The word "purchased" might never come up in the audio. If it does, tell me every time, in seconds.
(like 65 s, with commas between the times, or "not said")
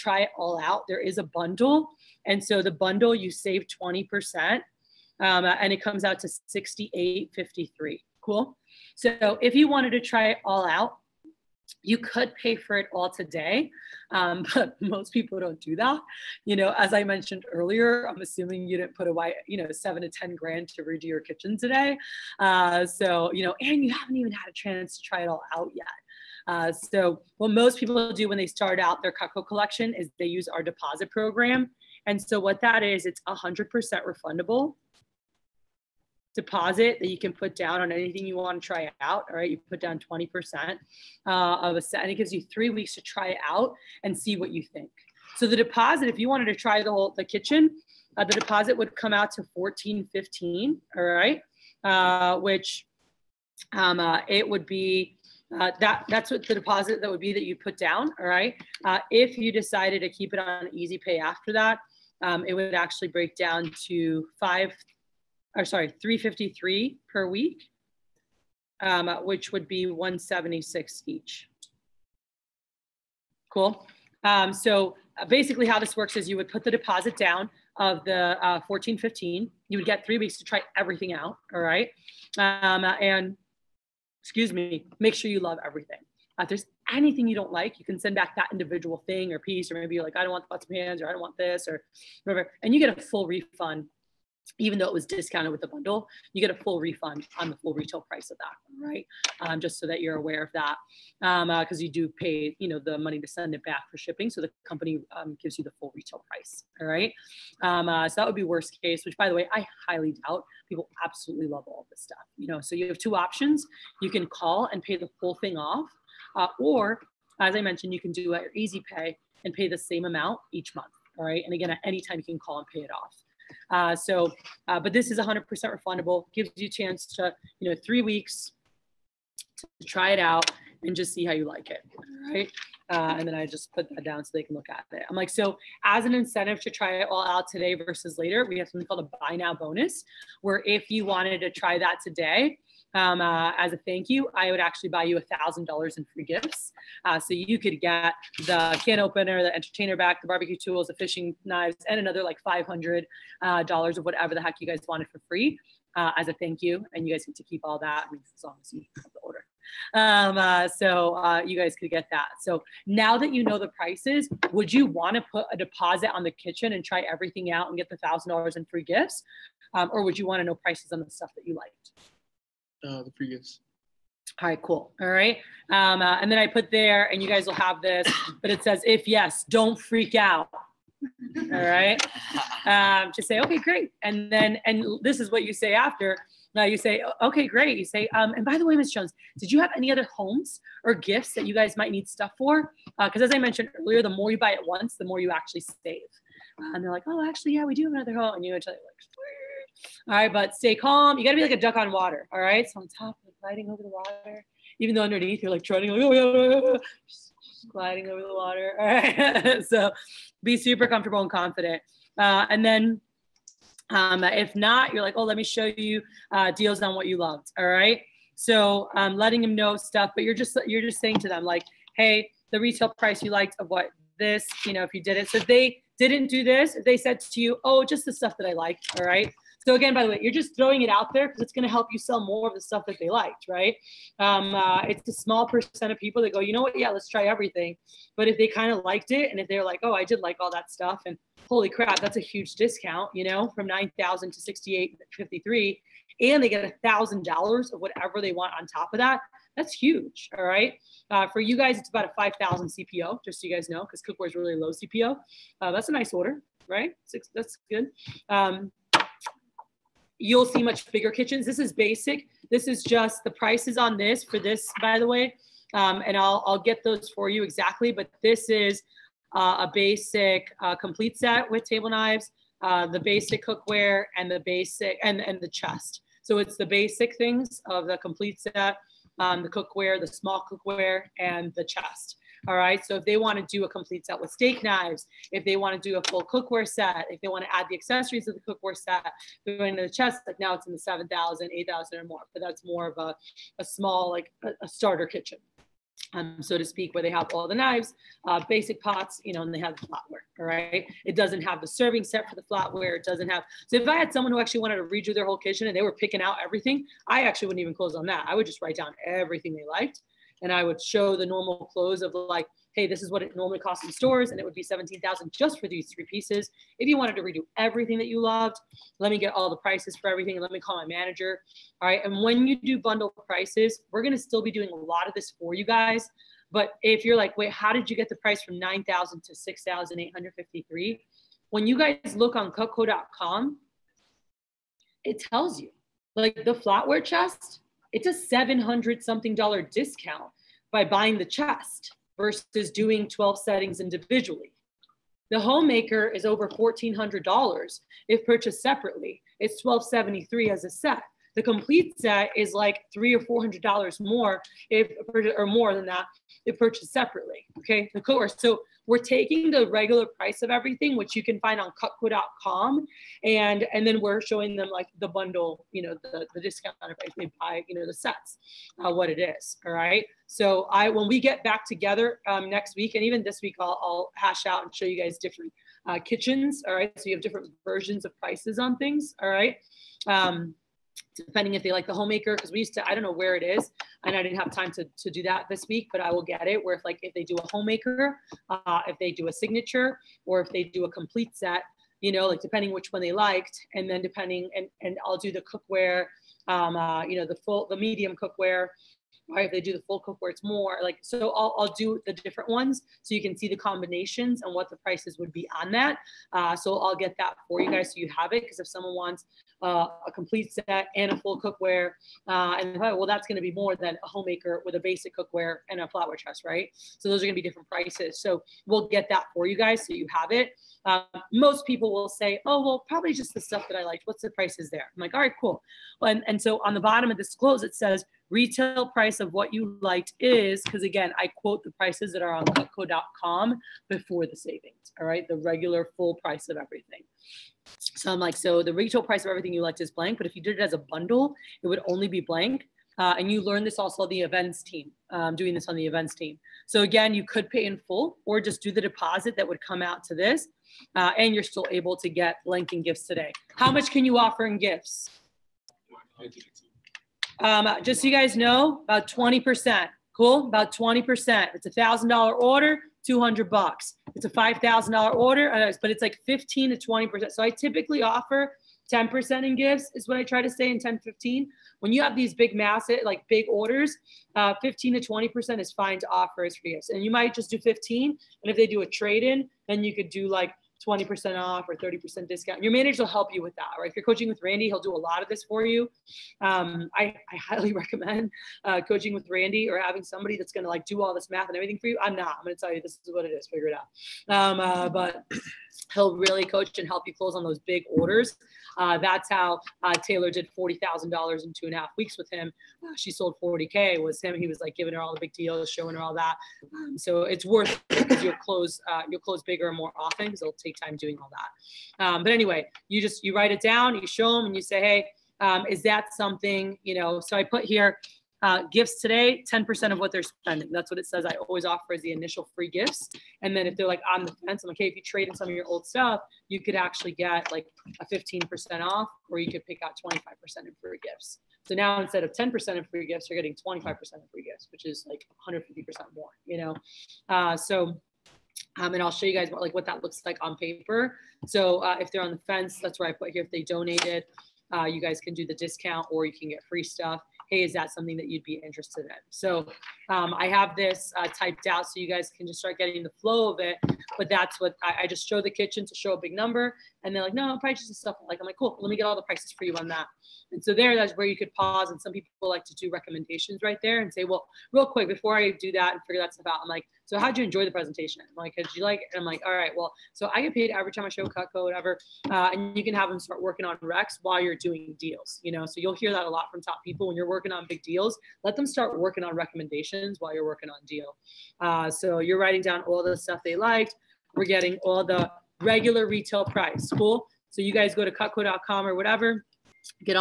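348 s, 356 s.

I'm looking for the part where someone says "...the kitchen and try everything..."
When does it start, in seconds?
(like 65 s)
166 s.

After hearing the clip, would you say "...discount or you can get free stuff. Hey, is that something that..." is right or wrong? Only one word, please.
right.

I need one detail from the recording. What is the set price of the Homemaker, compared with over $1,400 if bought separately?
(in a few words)
1273.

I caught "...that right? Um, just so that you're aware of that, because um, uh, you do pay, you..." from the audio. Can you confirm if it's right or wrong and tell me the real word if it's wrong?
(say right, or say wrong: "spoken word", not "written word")
right.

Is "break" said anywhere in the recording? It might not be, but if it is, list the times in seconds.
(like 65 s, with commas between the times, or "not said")
63 s.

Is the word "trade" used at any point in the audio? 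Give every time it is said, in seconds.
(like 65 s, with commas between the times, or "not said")
478 s, 525 s.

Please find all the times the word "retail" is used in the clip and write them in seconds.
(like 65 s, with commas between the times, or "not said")
97 s, 105 s, 222 s, 428 s, 438 s, 586 s.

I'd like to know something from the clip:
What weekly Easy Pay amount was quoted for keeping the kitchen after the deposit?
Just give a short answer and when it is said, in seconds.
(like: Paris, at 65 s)
353, at 66 s.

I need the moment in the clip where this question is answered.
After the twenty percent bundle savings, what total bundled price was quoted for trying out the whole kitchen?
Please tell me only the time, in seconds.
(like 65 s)
6 s.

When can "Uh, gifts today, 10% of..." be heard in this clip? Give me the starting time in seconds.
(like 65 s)
518 s.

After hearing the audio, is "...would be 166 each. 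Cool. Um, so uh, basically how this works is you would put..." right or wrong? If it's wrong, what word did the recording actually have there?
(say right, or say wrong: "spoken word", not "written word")
wrong: "176", not "166".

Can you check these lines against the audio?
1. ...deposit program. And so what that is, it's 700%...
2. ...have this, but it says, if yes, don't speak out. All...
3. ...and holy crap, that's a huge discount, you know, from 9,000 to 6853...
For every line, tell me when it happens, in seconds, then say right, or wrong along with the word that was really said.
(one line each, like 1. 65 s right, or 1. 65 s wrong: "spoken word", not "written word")
1. 30 s wrong: "100", not "700"
2. 177 s wrong: "freak", not "speak"
3. 241 s right.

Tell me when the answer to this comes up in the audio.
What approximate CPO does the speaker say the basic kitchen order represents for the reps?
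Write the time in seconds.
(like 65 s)
252 s.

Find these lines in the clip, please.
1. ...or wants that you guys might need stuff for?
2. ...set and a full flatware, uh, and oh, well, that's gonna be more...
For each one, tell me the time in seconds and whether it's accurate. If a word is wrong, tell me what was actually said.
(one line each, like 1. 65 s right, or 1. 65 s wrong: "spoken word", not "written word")
1. 190 s wrong: "gifts", not "wants"
2. 410 s wrong: "cookware", not "flatware".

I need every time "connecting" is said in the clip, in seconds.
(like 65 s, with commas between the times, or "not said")
not said.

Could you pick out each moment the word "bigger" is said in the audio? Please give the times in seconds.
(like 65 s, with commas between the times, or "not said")
260 s, 509 s.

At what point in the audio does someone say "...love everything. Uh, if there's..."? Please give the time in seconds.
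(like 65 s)
85 s.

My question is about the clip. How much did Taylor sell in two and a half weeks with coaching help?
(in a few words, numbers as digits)
$40,000.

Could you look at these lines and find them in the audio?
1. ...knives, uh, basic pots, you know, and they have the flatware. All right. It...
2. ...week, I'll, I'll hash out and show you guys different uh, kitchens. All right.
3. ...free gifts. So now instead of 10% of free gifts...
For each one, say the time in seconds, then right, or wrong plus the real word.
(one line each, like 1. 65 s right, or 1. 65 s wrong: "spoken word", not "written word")
1. 297 s right
2. 373 s right
3. 530 s right.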